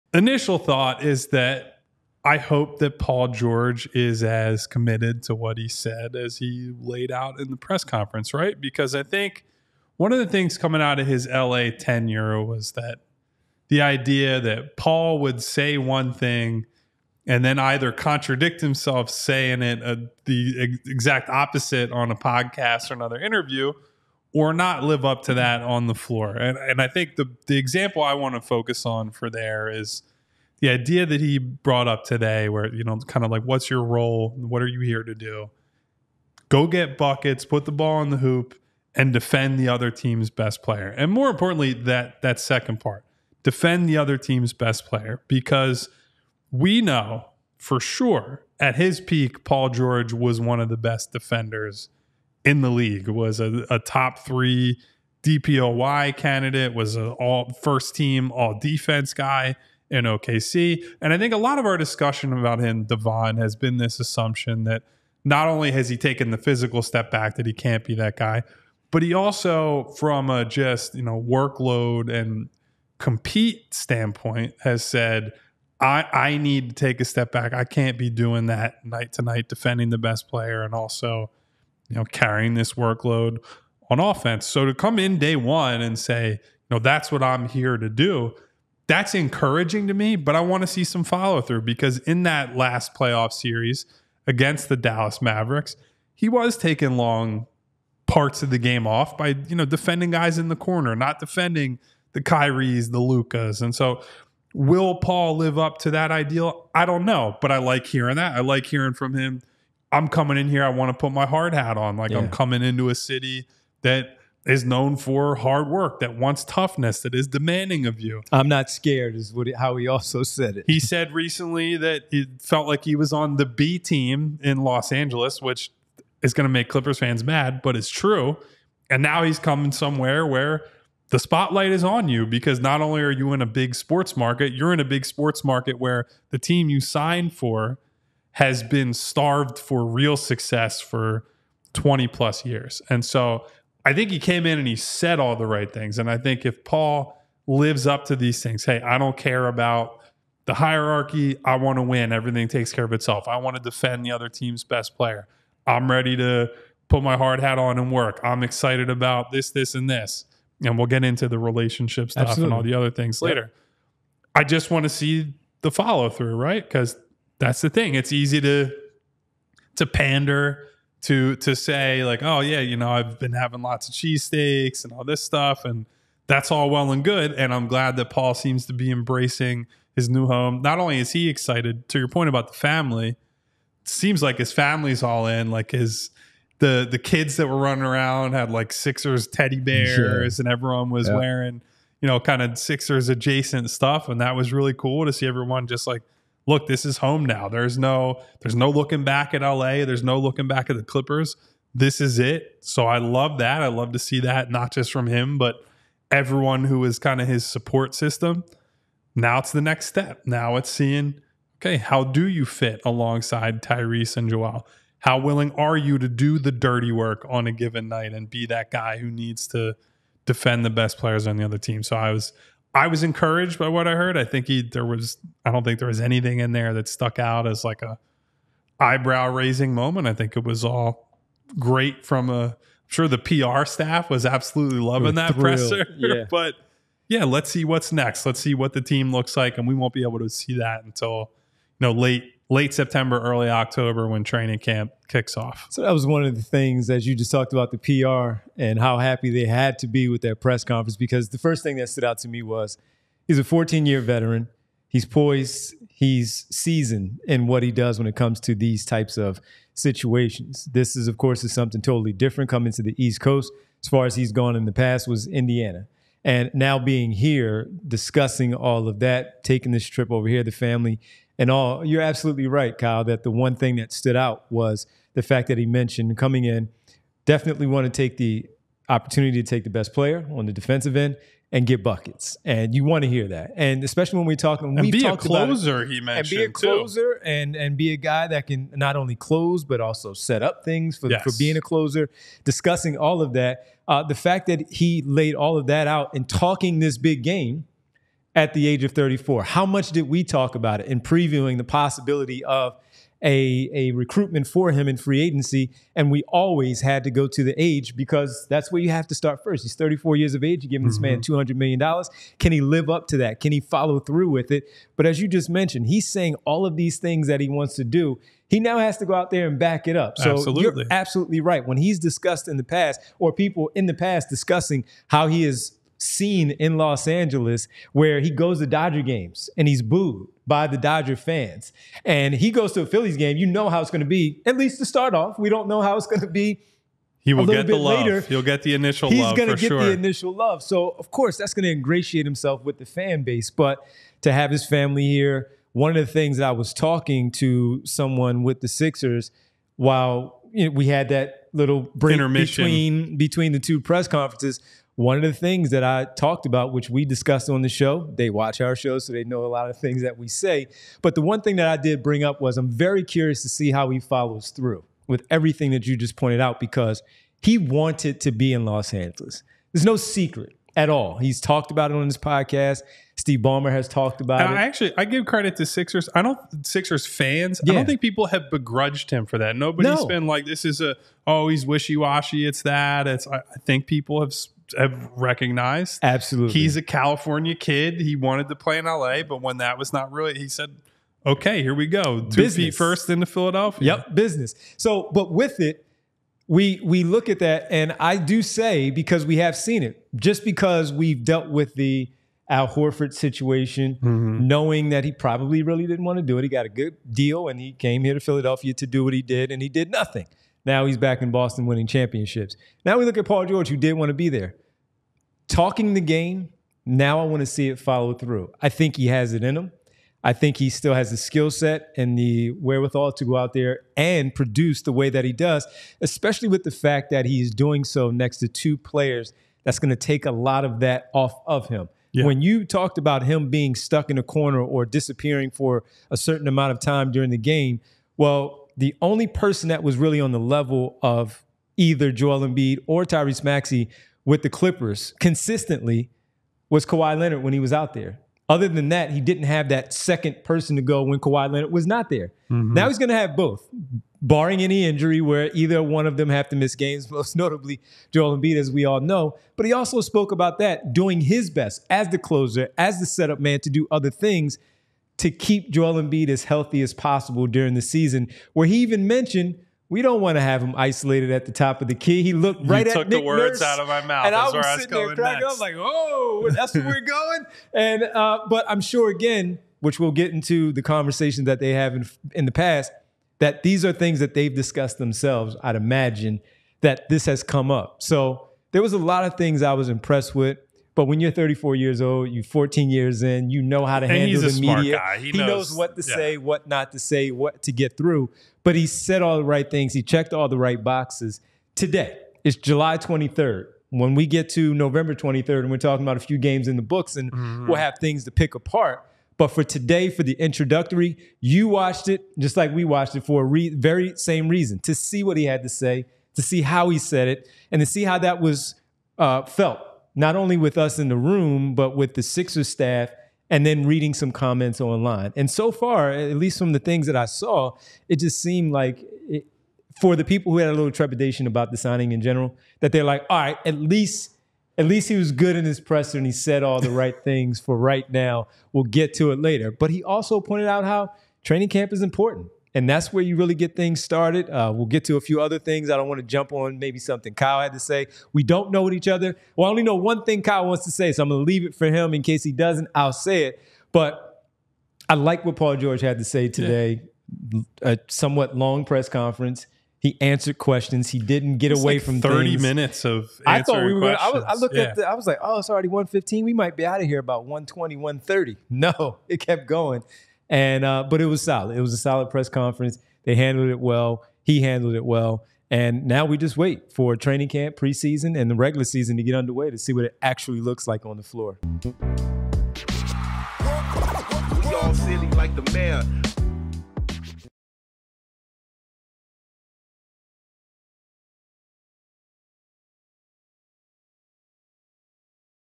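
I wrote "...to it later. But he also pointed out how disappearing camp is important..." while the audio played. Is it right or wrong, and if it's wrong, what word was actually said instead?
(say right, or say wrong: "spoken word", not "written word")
wrong: "training", not "disappearing".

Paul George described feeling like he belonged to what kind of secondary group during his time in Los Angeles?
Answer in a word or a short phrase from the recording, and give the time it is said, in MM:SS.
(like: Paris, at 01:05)
The B team, at 02:03.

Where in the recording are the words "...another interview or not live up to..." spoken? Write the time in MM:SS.
00:22.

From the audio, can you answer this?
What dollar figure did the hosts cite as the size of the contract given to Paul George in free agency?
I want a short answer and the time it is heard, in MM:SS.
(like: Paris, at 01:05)
$200 million, at 05:11.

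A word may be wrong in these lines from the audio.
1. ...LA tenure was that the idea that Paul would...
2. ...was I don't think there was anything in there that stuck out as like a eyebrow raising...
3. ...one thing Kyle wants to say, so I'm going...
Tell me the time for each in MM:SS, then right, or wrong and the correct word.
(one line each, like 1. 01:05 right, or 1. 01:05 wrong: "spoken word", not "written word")
1. 00:11 right
2. 03:44 right
3. 09:09 right.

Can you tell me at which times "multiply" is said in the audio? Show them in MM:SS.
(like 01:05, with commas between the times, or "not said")
not said.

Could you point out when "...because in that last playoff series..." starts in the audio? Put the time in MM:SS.
01:31.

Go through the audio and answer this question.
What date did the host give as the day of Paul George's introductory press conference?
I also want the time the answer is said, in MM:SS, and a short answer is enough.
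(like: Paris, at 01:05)
July 23rd, at 08:22.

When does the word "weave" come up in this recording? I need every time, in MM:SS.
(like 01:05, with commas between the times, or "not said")
not said.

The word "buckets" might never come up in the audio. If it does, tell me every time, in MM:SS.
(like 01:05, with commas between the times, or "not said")
00:36, 04:41.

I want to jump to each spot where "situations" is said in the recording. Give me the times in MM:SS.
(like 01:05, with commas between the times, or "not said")
04:19, 06:43.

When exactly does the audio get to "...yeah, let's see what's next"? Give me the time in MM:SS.
03:57.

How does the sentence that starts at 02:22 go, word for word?
And so I think he came in and he said all the right things.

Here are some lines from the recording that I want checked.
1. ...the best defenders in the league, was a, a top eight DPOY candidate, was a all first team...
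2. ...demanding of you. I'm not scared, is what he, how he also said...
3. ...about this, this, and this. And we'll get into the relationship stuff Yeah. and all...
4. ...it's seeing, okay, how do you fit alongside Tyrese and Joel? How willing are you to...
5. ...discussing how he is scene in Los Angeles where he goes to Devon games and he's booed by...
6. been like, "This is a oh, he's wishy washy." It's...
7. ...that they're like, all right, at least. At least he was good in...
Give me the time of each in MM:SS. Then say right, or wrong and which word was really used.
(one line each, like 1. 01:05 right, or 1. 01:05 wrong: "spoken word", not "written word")
1. 00:50 wrong: "three", not "eight"
2. 01:57 right
3. 02:38 wrong: "Absolutely", not "Yeah"
4. 03:30 right
5. 05:24 wrong: "Dodger", not "Devon"
6. 06:20 right
7. 08:52 right.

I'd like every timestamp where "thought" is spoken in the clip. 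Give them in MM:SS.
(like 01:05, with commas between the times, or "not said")
00:00, 09:23.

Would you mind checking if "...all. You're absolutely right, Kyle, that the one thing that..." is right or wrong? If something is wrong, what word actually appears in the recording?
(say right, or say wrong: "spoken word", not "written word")
right.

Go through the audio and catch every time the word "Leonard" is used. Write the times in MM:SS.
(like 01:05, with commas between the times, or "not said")
07:27, 07:31.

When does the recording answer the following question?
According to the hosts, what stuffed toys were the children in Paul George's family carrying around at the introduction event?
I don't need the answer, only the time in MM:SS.
03:08.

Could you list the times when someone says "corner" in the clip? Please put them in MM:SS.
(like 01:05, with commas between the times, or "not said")
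01:40, 07:14.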